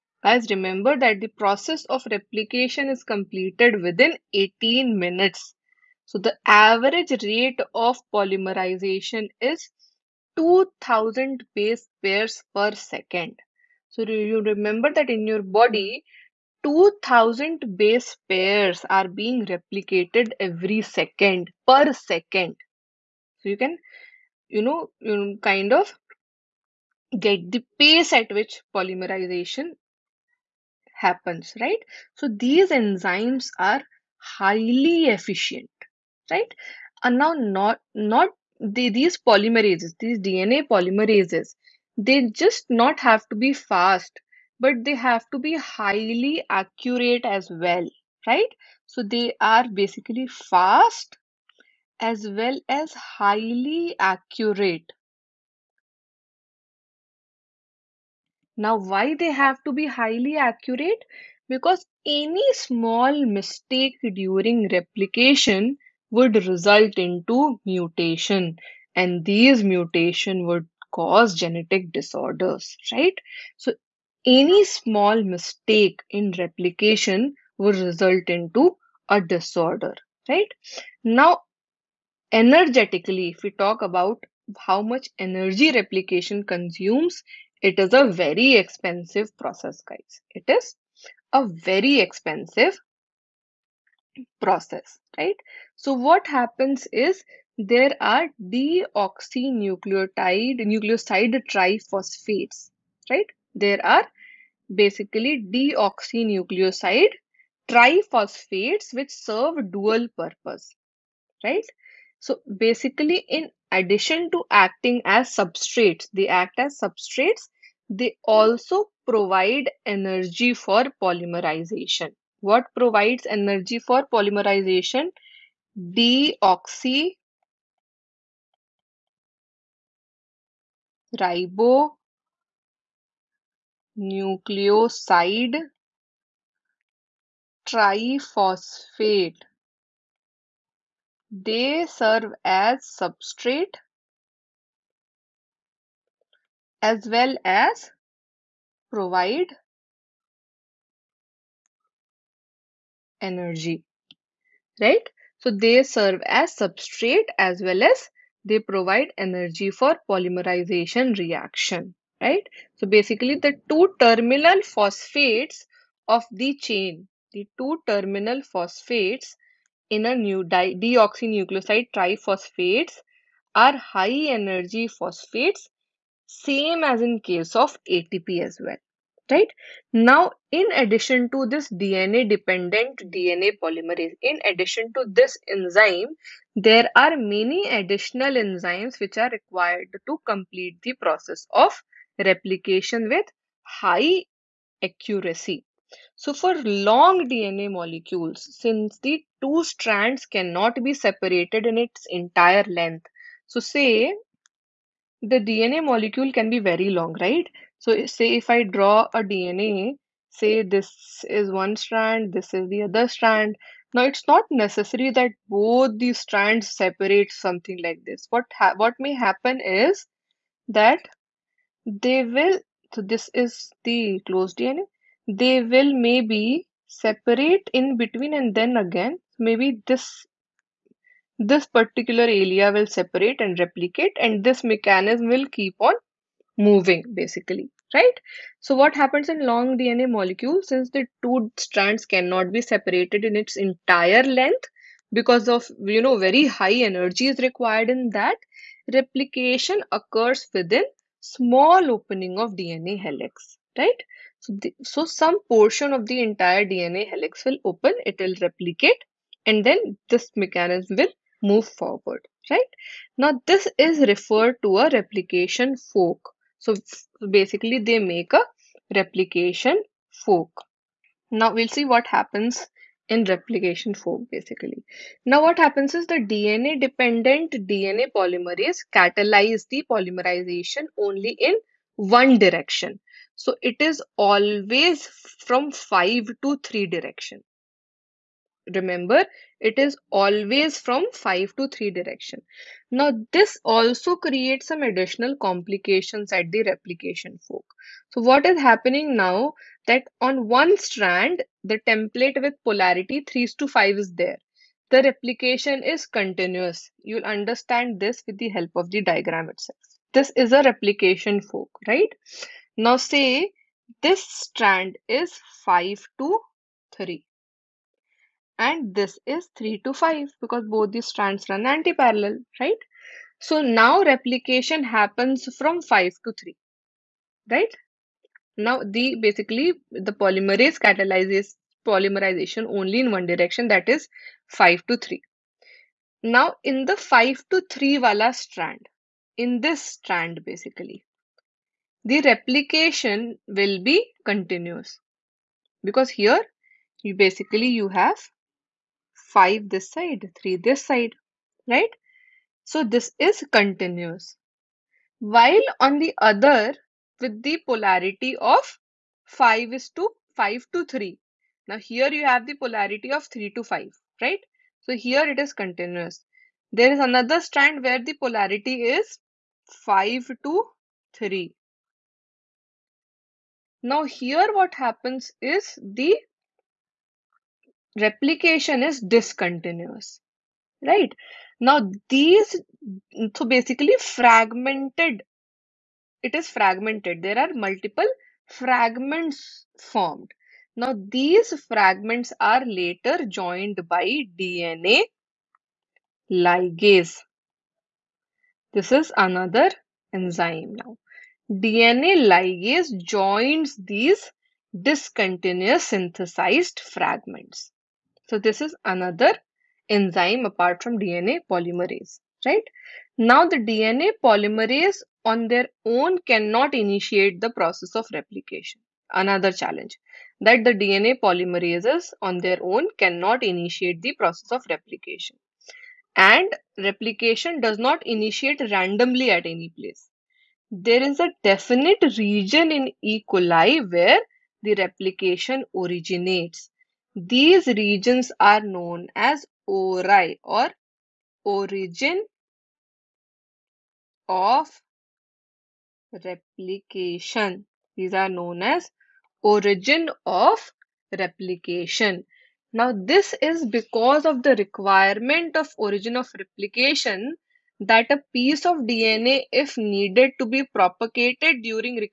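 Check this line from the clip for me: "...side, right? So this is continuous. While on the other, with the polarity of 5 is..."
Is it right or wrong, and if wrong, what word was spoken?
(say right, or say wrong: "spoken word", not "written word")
right.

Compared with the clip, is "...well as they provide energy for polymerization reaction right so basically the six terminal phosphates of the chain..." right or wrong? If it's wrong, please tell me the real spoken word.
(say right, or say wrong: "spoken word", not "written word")
wrong: "two", not "six".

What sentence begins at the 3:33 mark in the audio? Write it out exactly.
Now it's not necessary that both these strands separate something like this.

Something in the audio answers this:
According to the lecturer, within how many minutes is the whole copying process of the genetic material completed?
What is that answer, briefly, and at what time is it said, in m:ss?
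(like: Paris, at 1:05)
18 minutes, at 0:04.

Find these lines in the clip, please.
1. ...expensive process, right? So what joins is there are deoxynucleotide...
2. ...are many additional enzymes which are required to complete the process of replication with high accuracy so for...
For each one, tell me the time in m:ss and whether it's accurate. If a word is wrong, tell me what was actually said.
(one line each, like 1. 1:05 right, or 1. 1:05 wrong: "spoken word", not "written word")
1. 1:31 wrong: "happens", not "joins"
2. 3:06 right.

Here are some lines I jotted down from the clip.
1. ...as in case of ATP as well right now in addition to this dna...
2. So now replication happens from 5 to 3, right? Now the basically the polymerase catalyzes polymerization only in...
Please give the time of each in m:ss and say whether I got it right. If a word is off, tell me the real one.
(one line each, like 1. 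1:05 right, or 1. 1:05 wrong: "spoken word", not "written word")
1. 2:56 right
2. 5:23 right.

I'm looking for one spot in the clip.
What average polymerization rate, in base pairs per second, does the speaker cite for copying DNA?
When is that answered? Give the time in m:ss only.
0:10.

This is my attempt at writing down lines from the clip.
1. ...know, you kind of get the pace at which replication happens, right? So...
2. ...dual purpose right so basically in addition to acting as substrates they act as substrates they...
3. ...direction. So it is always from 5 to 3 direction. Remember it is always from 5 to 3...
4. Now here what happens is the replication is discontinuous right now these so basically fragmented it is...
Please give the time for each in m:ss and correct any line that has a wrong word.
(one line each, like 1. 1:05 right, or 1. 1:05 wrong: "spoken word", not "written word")
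1. 0:24 wrong: "polymerization", not "replication"
2. 1:49 right
3. 4:42 right
4. 6:13 right.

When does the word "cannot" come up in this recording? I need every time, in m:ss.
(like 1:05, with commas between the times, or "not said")
3:20, 4:02, 6:56, 7:02.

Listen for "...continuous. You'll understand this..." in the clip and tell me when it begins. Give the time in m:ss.
5:06.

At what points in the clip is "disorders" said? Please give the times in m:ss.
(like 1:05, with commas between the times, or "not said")
1:11, 1:19.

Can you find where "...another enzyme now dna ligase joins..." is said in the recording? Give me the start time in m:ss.
6:39.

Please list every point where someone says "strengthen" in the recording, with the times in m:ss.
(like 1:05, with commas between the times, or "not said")
not said.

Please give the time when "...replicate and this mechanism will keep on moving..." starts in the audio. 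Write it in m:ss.
3:53.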